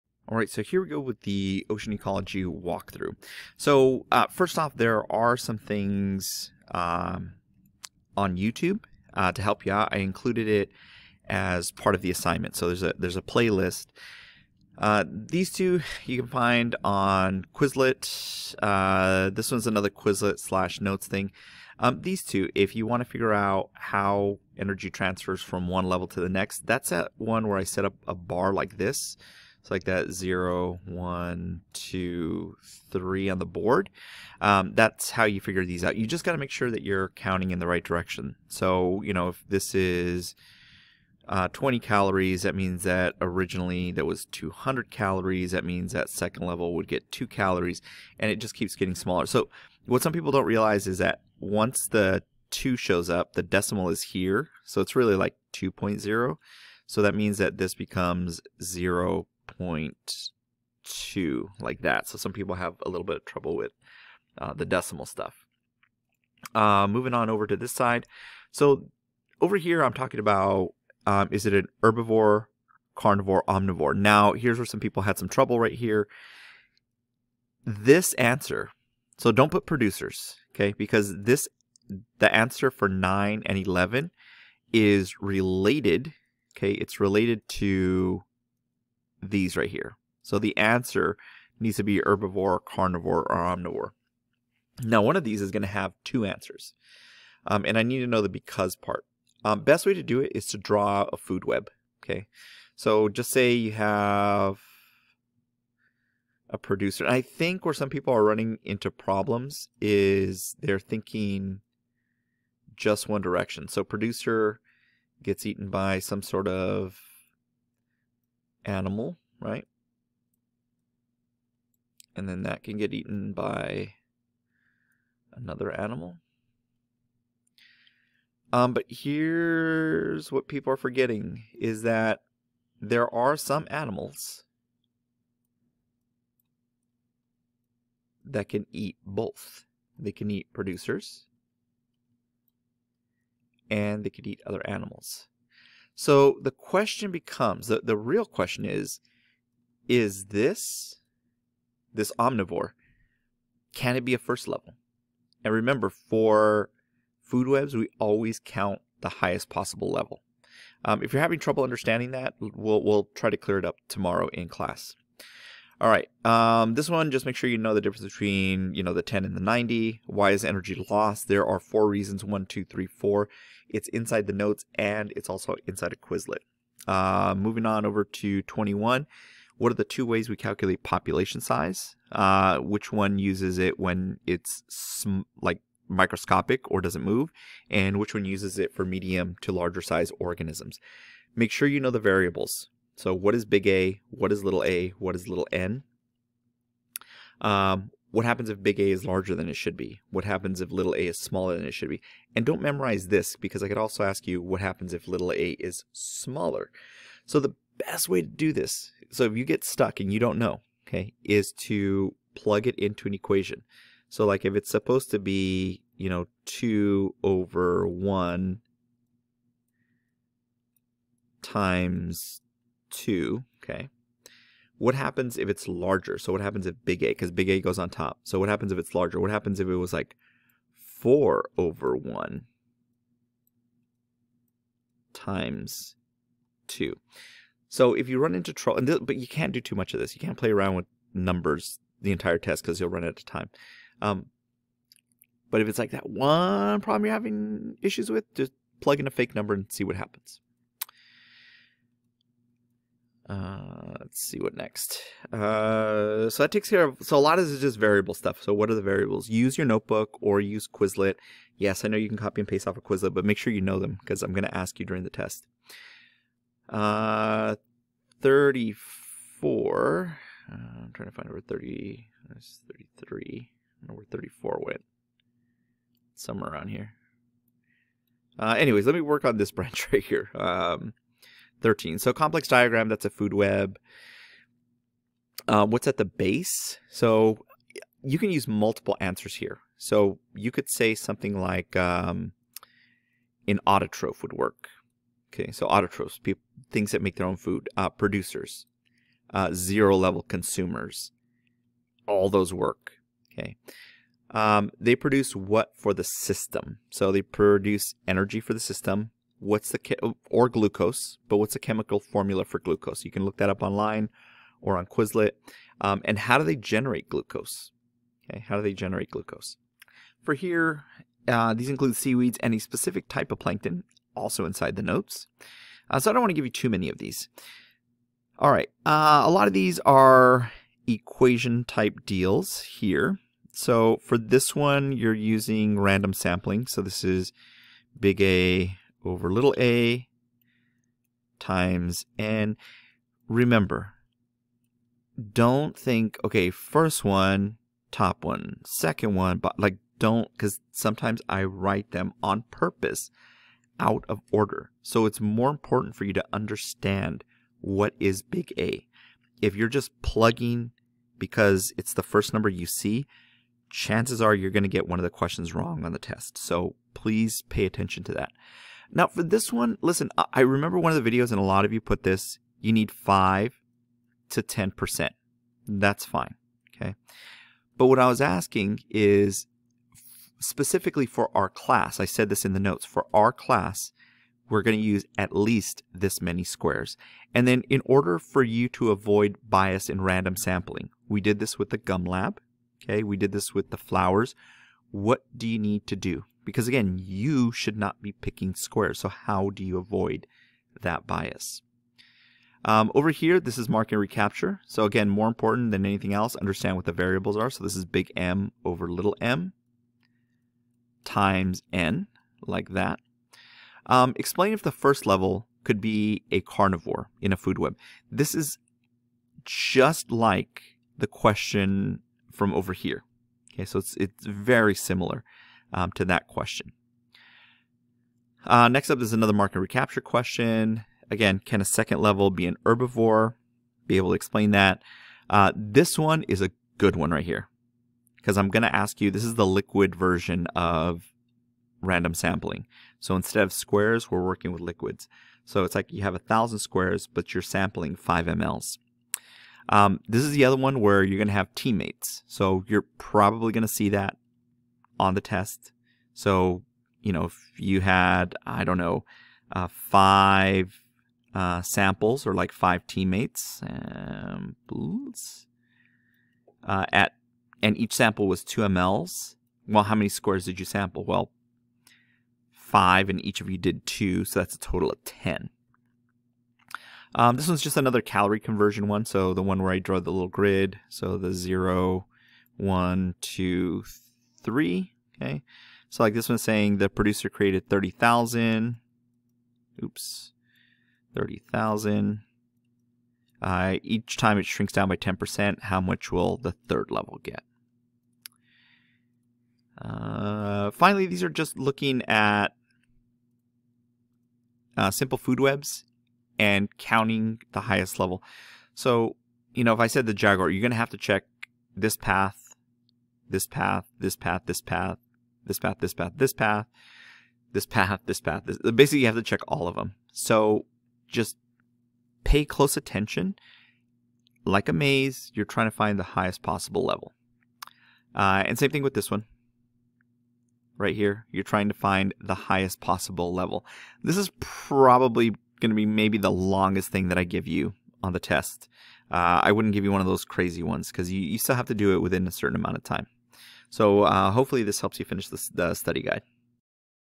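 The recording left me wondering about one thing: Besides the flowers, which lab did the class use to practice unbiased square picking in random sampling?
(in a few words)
gum lab.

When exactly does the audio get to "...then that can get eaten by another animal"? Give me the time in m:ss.
2:02.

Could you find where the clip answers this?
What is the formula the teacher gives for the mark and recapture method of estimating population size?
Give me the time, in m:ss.
6:47.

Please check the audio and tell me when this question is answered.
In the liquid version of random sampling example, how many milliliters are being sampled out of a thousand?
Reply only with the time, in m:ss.
7:27.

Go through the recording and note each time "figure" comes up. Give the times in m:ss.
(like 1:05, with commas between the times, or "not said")
0:23, 0:35.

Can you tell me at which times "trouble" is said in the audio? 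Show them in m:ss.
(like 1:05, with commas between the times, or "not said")
1:03, 1:15, 2:41, 3:58.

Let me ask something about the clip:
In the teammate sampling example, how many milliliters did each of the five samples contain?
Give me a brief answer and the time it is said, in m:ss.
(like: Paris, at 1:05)
2 mL, at 7:48.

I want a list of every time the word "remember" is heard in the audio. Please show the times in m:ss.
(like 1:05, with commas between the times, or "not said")
2:35, 5:43, 6:10.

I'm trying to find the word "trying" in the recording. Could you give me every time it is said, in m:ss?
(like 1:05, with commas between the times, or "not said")
4:30, 8:45, 8:51.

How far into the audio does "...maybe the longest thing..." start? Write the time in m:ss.
8:55.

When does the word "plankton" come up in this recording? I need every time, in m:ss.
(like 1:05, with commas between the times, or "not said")
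5:23.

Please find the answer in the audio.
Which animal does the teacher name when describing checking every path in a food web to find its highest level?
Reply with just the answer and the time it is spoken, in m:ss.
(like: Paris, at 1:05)
Jaguar, at 8:30.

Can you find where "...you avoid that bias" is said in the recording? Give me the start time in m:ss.
6:39.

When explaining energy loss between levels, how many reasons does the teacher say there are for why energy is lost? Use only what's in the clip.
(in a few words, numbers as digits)
4.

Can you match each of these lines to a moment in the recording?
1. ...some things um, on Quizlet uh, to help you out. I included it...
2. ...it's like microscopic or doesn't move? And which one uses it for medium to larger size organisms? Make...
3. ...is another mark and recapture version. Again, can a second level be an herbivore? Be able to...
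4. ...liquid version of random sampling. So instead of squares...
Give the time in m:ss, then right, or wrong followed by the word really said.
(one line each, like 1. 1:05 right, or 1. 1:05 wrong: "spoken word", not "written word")
1. 0:05 wrong: "YouTube", not "Quizlet"
2. 3:04 right
3. 7:09 wrong: "question", not "version"
4. 7:19 right.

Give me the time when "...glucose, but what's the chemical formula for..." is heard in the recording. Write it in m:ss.
5:10.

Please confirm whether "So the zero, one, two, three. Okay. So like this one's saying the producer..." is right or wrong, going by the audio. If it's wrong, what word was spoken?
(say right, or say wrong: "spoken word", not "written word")
right.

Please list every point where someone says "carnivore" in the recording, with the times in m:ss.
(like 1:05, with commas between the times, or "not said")
1:12, 1:32, 6:56.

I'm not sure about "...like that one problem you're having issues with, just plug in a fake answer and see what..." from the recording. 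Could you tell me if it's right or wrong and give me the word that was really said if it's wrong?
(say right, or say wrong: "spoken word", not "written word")
wrong: "number", not "answer".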